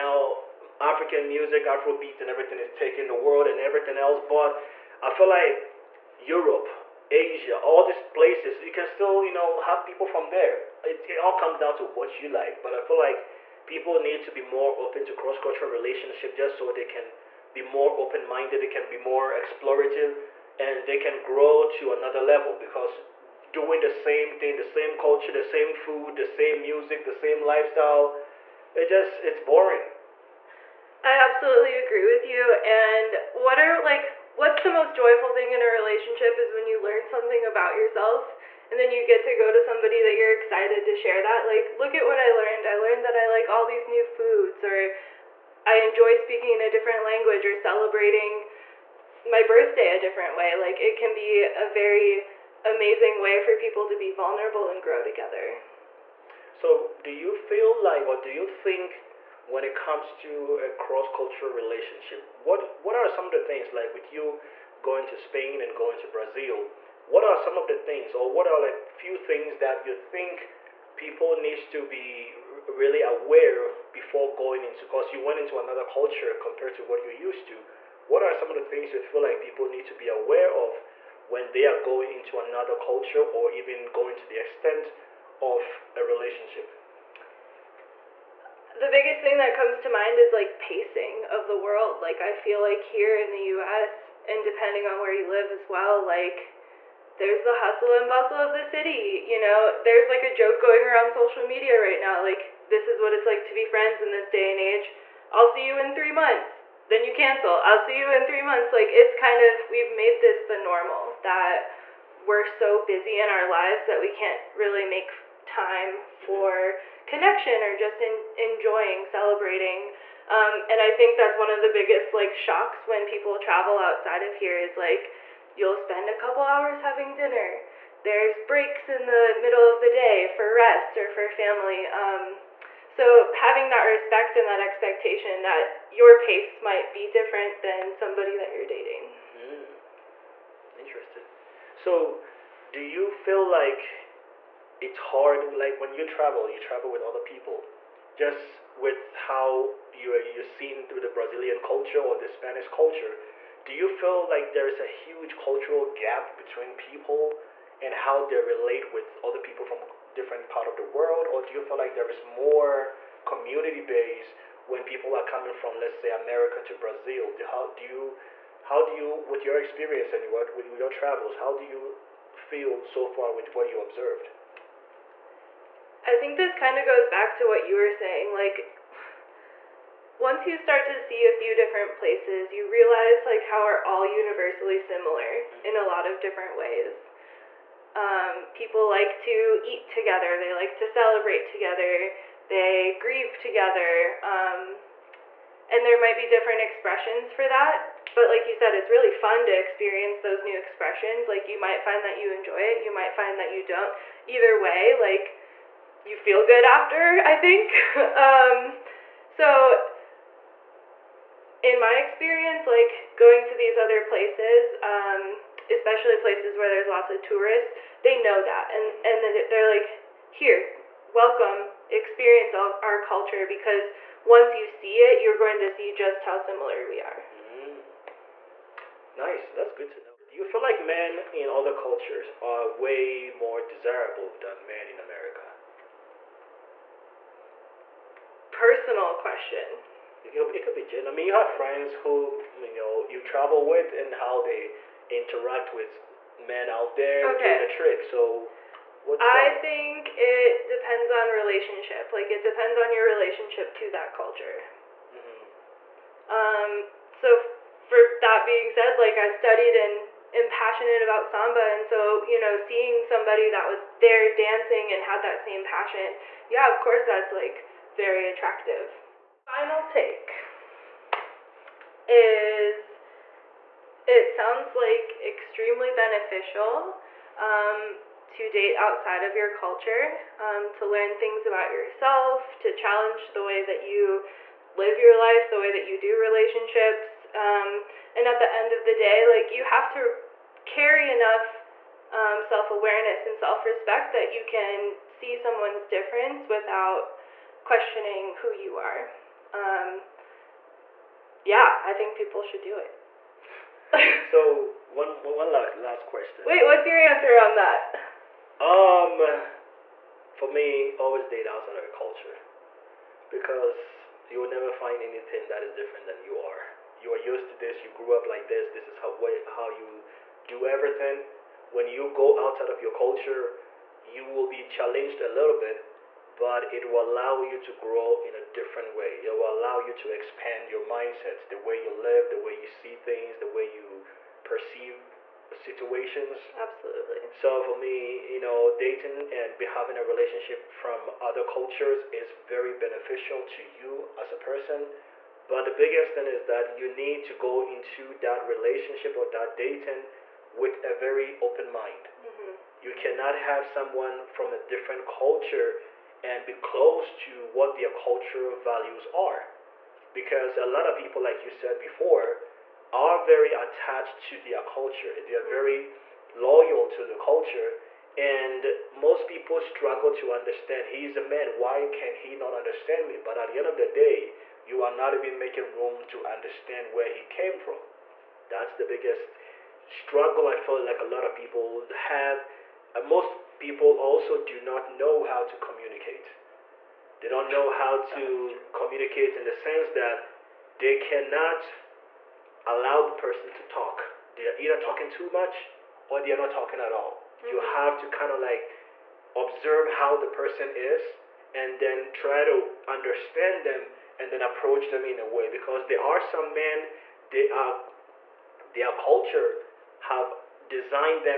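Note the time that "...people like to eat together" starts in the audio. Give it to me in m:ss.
3:08.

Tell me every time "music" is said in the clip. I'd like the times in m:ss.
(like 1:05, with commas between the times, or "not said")
0:01, 0:26.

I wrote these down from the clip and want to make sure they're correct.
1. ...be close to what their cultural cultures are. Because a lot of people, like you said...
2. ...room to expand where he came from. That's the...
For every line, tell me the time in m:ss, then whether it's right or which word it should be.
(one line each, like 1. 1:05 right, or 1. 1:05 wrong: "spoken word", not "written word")
1. 5:56 wrong: "values", not "cultures"
2. 6:15 wrong: "understand", not "expand".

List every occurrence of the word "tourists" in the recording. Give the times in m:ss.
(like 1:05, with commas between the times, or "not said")
3:37.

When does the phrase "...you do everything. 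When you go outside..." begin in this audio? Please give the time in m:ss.
5:19.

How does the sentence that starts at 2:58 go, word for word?
Like, once you start to see a few different places, you realize like how are all universally similar mm-hmm.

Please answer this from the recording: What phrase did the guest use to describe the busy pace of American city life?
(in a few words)
hustle and bustle.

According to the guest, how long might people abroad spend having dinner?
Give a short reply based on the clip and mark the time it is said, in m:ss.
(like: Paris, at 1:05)
A couple hours, at 2:06.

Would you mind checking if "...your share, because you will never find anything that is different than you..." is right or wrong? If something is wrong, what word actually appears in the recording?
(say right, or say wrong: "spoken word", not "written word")
wrong: "culture", not "share".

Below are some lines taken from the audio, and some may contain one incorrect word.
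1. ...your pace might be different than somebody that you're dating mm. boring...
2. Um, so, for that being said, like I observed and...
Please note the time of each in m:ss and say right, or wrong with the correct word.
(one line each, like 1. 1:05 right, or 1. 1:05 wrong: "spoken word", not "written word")
1. 2:15 wrong: "interesting", not "boring"
2. 4:16 wrong: "studied", not "observed".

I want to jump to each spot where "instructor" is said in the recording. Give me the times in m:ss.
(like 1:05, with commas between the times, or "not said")
not said.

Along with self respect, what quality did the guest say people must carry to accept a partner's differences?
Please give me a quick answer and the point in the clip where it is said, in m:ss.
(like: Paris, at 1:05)
Self awareness, at 4:52.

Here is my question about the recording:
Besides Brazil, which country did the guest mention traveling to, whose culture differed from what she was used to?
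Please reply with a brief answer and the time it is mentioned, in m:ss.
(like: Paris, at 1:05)
Spain, at 1:05.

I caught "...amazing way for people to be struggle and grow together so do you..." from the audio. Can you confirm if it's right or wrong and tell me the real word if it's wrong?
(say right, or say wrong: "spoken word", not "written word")
wrong: "vulnerable", not "struggle".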